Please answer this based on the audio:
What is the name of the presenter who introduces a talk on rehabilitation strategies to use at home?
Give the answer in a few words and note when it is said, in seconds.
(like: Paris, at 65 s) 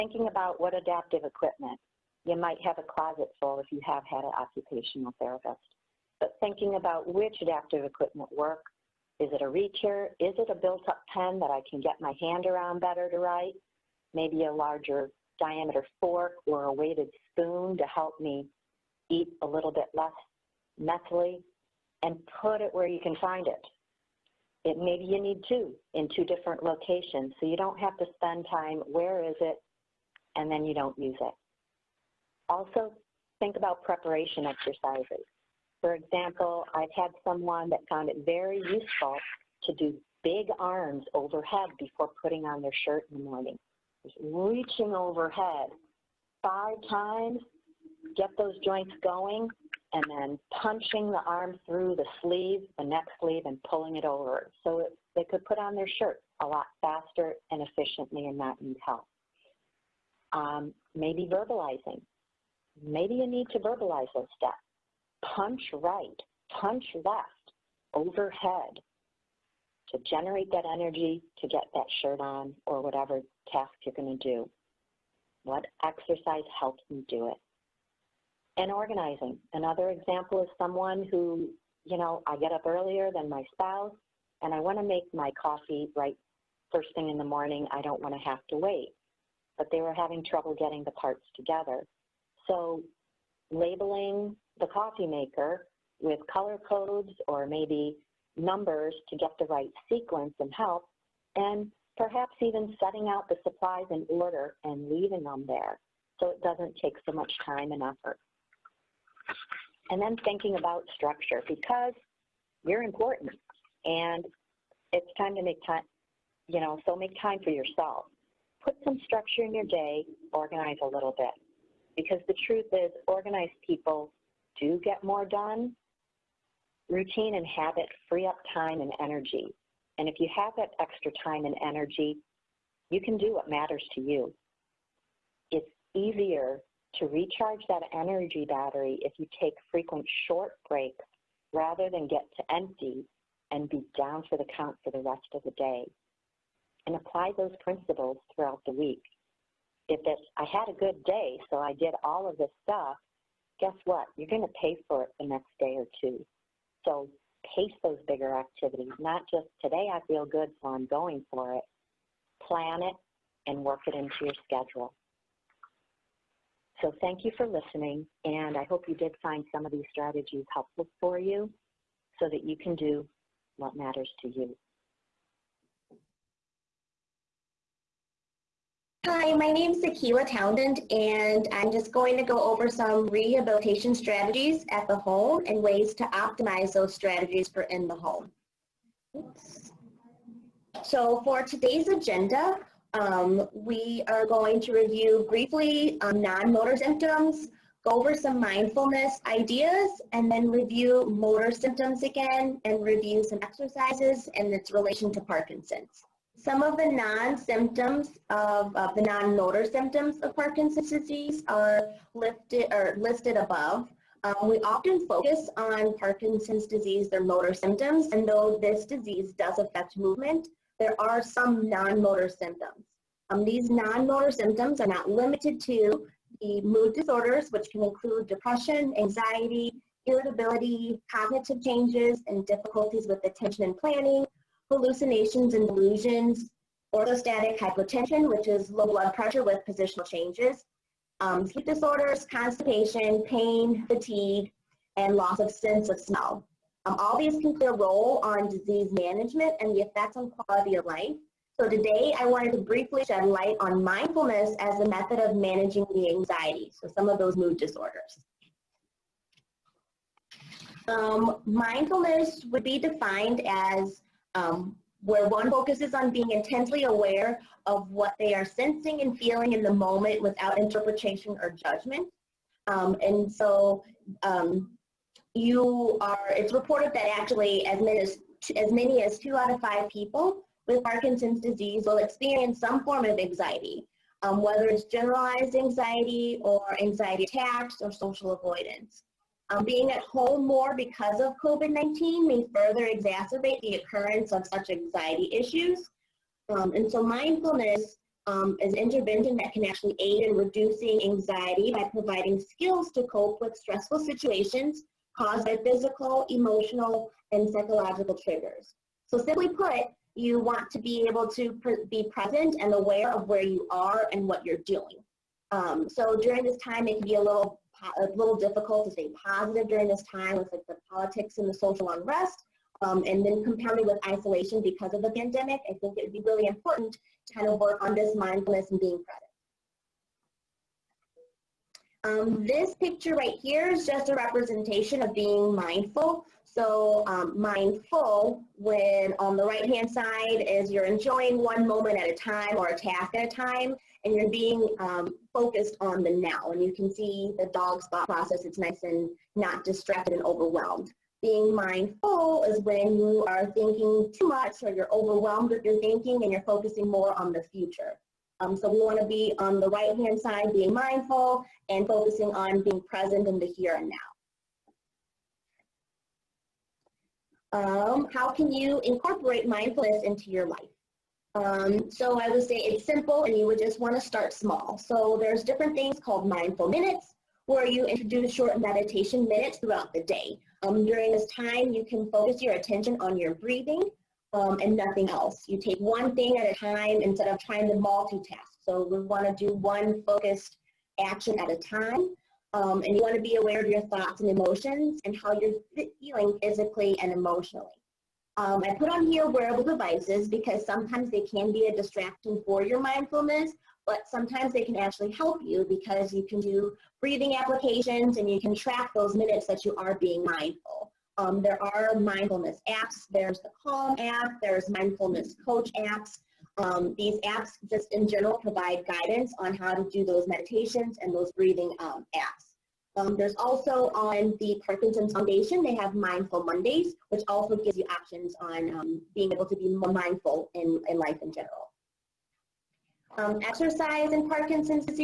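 Akila Townend, at 179 s.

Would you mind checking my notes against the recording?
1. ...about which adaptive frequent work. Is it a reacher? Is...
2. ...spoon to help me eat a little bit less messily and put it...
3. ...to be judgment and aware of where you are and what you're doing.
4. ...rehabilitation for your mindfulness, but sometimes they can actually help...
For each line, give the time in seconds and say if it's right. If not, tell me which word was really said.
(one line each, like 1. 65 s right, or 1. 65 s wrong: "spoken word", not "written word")
1. 6 s wrong: "equipment", not "frequent"
2. 17 s right
3. 311 s wrong: "present", not "judgment"
4. 401 s wrong: "distraction", not "rehabilitation".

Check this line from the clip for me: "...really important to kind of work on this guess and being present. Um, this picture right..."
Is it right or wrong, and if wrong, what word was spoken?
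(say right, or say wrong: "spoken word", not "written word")
wrong: "mindfulness", not "guess".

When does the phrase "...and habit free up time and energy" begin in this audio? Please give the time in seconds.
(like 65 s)
127 s.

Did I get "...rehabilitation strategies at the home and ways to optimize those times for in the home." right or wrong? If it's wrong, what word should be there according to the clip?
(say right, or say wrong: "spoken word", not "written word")
wrong: "strategies", not "times".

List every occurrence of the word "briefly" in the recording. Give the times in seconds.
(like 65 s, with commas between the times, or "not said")
195 s, 252 s.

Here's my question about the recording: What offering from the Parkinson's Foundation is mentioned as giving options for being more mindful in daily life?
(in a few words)
Mindful Mondays.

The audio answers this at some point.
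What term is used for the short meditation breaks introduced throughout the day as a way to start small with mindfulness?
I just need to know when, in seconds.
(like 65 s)
376 s.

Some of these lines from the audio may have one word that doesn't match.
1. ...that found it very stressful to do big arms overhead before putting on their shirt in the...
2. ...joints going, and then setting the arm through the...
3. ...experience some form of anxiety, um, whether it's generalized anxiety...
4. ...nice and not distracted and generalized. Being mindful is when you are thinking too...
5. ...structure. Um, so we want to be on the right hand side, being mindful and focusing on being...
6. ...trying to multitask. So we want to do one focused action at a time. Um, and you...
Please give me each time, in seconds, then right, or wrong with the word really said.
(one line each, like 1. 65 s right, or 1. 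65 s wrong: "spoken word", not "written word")
1. 37 s wrong: "useful", not "stressful"
2. 48 s wrong: "punching", not "setting"
3. 281 s right
4. 348 s wrong: "overwhelmed", not "generalized"
5. 357 s wrong: "future", not "structure"
6. 387 s right.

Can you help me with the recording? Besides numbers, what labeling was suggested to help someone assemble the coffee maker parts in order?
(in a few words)
color codes.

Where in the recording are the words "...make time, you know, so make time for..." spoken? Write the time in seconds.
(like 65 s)
115 s.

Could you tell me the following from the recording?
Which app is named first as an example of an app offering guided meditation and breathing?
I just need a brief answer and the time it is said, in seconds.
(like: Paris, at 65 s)
Calm, at 413 s.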